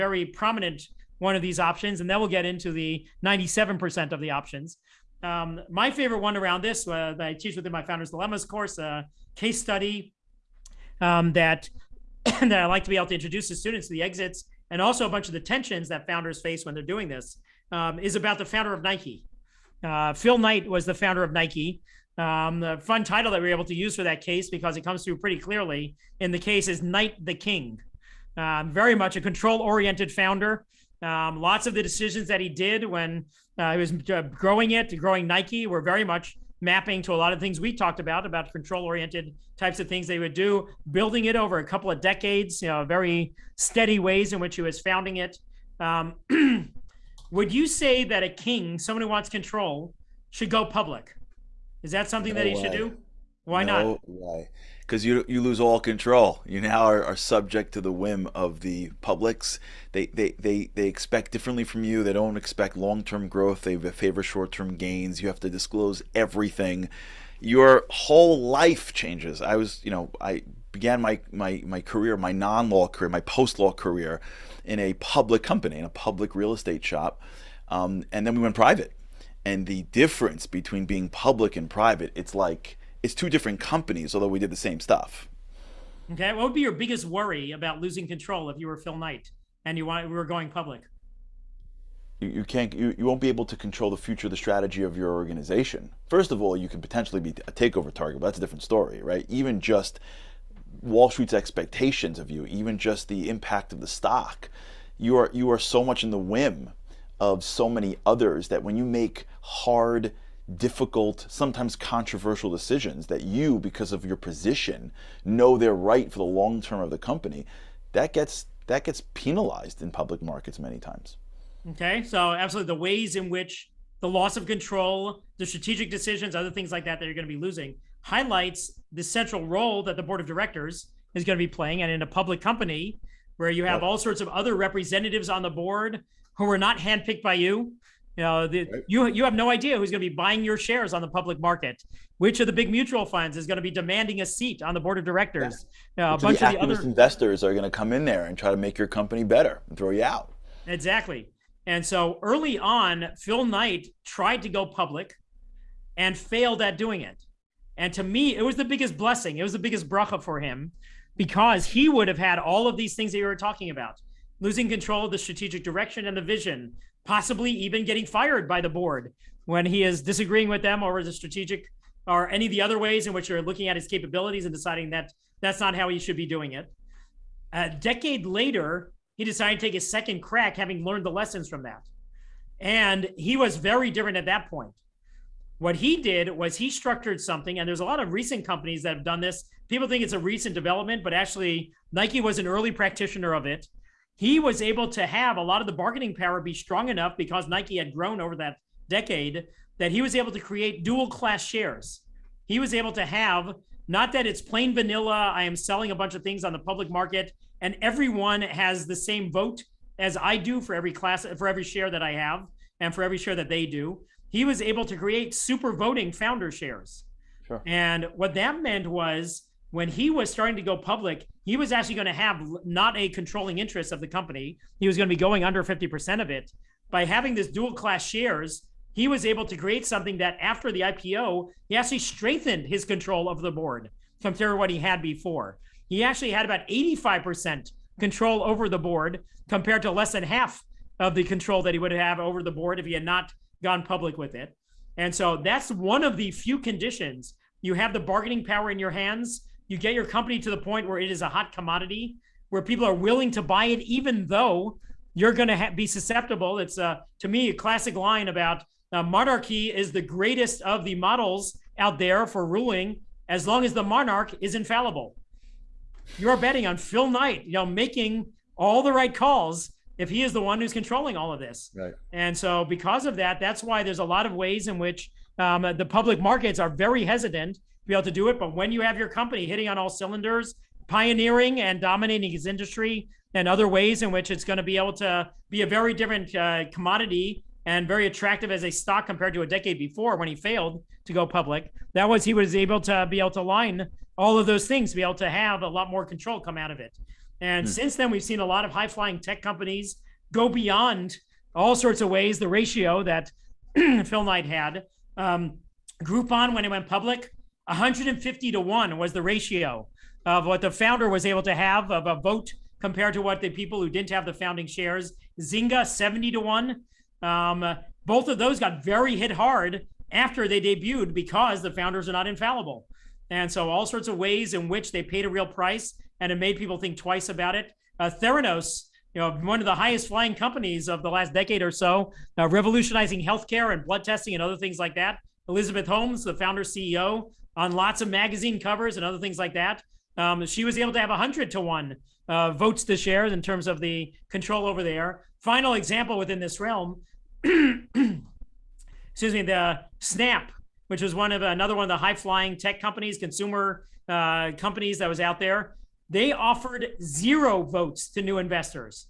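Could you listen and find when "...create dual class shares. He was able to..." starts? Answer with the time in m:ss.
3:20.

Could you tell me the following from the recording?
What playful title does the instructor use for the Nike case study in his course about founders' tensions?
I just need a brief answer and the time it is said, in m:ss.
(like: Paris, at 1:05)
Knight the King, at 0:26.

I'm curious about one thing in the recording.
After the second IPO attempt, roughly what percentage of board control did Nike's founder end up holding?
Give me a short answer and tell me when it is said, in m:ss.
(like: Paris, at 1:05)
85%, at 3:56.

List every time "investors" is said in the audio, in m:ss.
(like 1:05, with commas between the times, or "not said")
2:26, 5:58.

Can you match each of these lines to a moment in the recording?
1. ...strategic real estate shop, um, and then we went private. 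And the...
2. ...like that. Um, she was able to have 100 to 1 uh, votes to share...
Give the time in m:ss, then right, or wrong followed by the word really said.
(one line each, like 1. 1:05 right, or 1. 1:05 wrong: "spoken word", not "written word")
1. 1:15 wrong: "public", not "strategic"
2. 5:39 right.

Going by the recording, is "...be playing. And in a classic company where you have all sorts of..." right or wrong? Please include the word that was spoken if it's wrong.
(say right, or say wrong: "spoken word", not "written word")
wrong: "public", not "classic".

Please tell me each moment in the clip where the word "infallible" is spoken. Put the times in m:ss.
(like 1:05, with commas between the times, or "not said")
4:24, 5:22.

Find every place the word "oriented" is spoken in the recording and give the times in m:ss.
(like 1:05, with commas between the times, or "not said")
0:29, 0:38.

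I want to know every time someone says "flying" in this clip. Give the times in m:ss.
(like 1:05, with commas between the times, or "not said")
4:58, 5:30, 5:52.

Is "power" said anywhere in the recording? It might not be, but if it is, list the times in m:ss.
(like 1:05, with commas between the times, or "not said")
3:16, 4:08.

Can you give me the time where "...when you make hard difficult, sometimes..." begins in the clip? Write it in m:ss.
1:48.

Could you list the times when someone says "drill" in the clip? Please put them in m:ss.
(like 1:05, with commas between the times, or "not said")
not said.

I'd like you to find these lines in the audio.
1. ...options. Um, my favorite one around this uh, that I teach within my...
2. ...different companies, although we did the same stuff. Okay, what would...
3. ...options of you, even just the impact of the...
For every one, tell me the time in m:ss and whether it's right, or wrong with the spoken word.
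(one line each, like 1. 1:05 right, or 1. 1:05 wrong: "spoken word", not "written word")
1. 0:04 right
2. 1:23 right
3. 1:41 wrong: "expectations", not "options".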